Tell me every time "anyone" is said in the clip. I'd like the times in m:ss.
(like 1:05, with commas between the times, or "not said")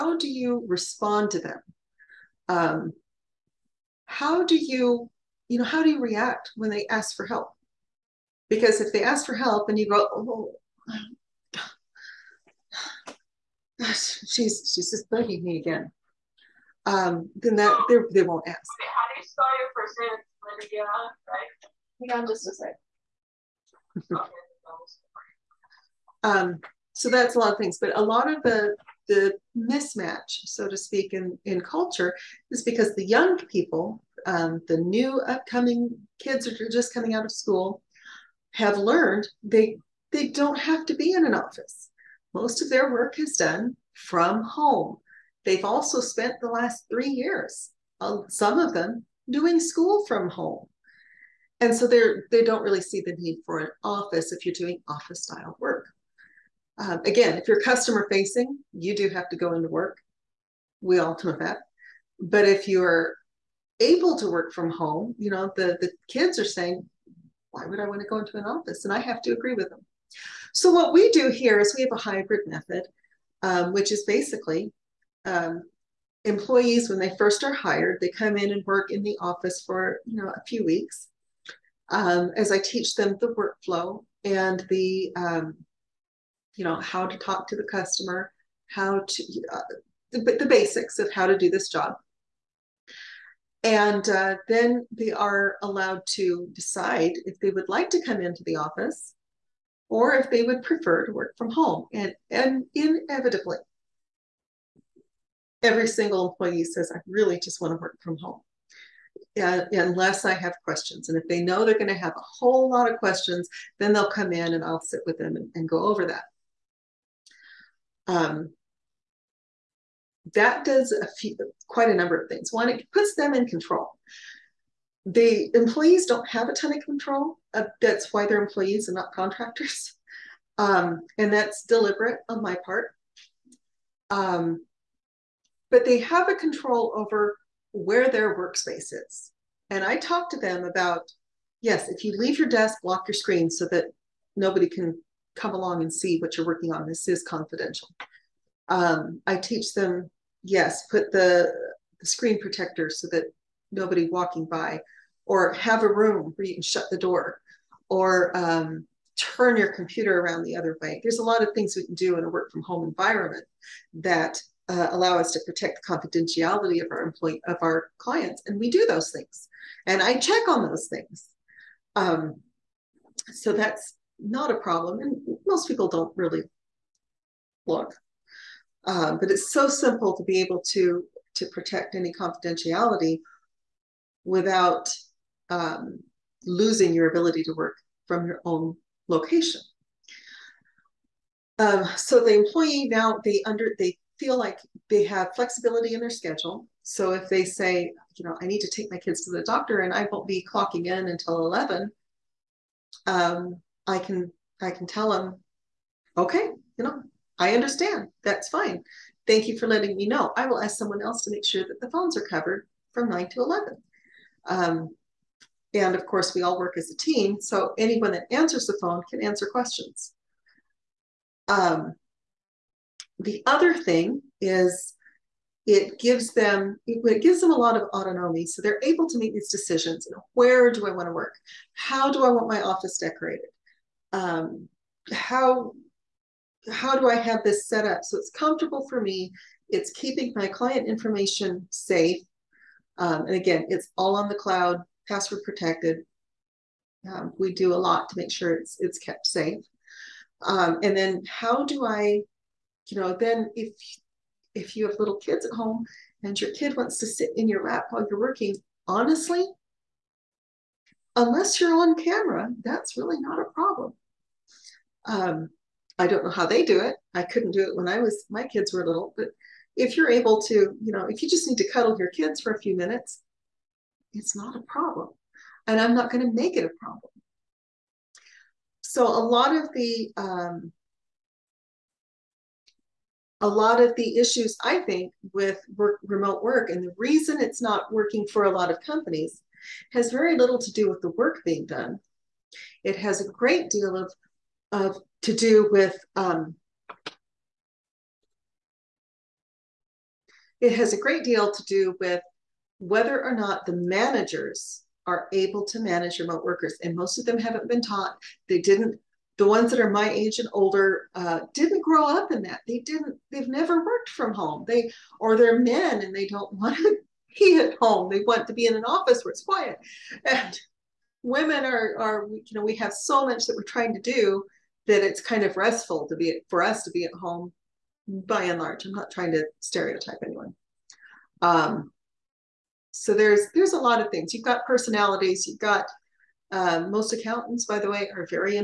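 3:37, 5:30.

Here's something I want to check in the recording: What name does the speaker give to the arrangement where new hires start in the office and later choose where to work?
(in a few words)
hybrid method.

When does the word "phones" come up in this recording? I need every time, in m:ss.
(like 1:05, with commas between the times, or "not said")
3:31, 3:38.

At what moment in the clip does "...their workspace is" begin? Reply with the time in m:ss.
2:18.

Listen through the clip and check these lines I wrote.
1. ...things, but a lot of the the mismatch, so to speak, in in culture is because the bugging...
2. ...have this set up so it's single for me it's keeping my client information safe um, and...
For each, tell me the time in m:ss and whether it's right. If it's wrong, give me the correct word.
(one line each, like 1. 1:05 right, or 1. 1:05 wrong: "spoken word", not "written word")
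1. 0:27 wrong: "young", not "bugging"
2. 3:57 wrong: "comfortable", not "single".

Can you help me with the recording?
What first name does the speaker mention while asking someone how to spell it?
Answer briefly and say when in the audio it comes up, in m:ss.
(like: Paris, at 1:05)
Lydia, at 0:20.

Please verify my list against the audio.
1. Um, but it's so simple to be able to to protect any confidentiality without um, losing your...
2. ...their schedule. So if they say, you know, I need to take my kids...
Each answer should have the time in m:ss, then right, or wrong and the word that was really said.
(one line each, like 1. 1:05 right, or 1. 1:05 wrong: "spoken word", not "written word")
1. 2:58 right
2. 3:16 right.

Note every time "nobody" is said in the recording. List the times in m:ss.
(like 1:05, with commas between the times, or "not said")
2:24, 2:33.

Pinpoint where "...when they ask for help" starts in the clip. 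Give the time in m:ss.
0:06.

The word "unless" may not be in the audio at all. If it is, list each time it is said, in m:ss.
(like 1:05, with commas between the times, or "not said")
1:49, 4:21.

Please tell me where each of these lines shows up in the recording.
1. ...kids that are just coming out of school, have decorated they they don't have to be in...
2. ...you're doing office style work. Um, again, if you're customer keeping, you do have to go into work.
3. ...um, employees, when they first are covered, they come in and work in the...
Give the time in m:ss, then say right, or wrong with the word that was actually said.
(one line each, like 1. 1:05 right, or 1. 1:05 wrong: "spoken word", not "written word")
1. 0:36 wrong: "learned", not "decorated"
2. 0:54 wrong: "facing", not "keeping"
3. 1:15 wrong: "hired", not "covered".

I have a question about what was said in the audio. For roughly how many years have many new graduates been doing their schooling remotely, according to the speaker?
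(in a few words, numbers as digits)
3 years.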